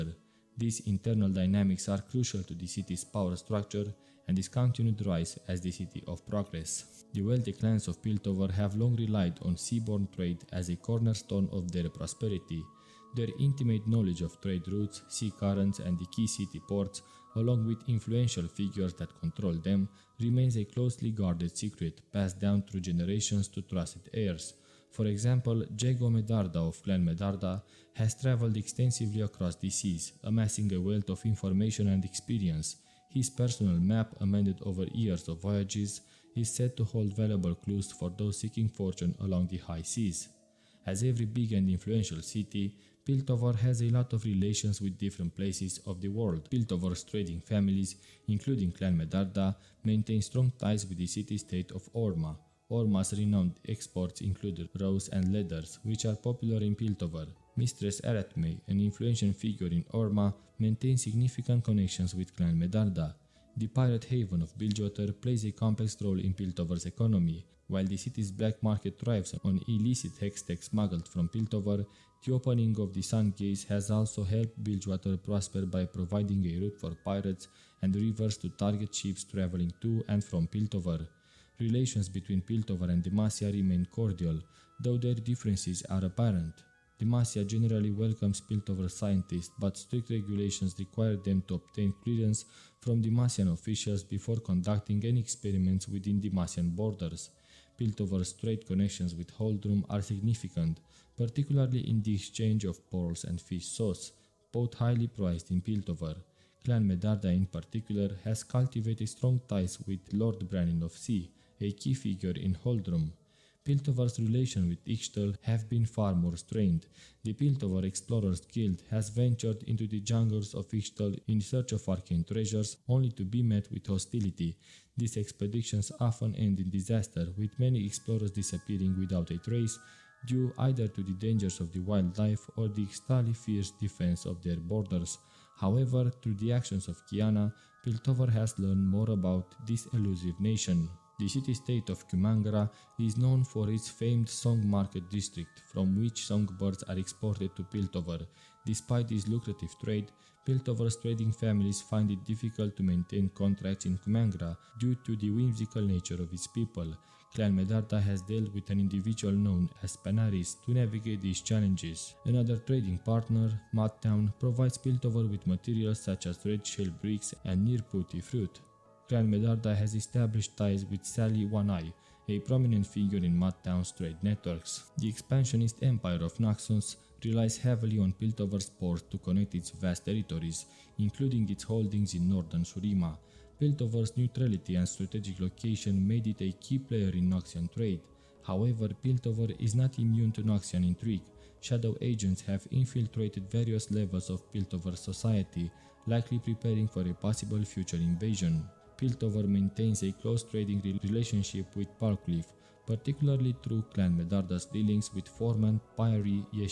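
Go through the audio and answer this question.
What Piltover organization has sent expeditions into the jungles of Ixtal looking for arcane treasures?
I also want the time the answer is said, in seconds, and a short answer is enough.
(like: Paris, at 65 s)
Piltover Explorers Guild, at 117 s.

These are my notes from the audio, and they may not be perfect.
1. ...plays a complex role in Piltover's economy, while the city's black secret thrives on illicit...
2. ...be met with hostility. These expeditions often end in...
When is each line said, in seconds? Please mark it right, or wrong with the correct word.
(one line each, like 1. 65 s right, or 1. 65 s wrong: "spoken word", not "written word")
1. 65 s wrong: "market", not "secret"
2. 123 s right.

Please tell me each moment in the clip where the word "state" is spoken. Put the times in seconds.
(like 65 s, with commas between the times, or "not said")
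51 s, 141 s.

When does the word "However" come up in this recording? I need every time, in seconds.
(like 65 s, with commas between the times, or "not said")
135 s, 188 s.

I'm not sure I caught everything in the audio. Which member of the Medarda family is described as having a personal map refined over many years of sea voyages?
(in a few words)
Jago Medarda.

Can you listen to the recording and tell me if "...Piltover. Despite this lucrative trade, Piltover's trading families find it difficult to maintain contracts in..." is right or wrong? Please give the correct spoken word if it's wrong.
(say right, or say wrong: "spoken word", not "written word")
right.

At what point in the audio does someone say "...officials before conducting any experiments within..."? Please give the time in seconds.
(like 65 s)
93 s.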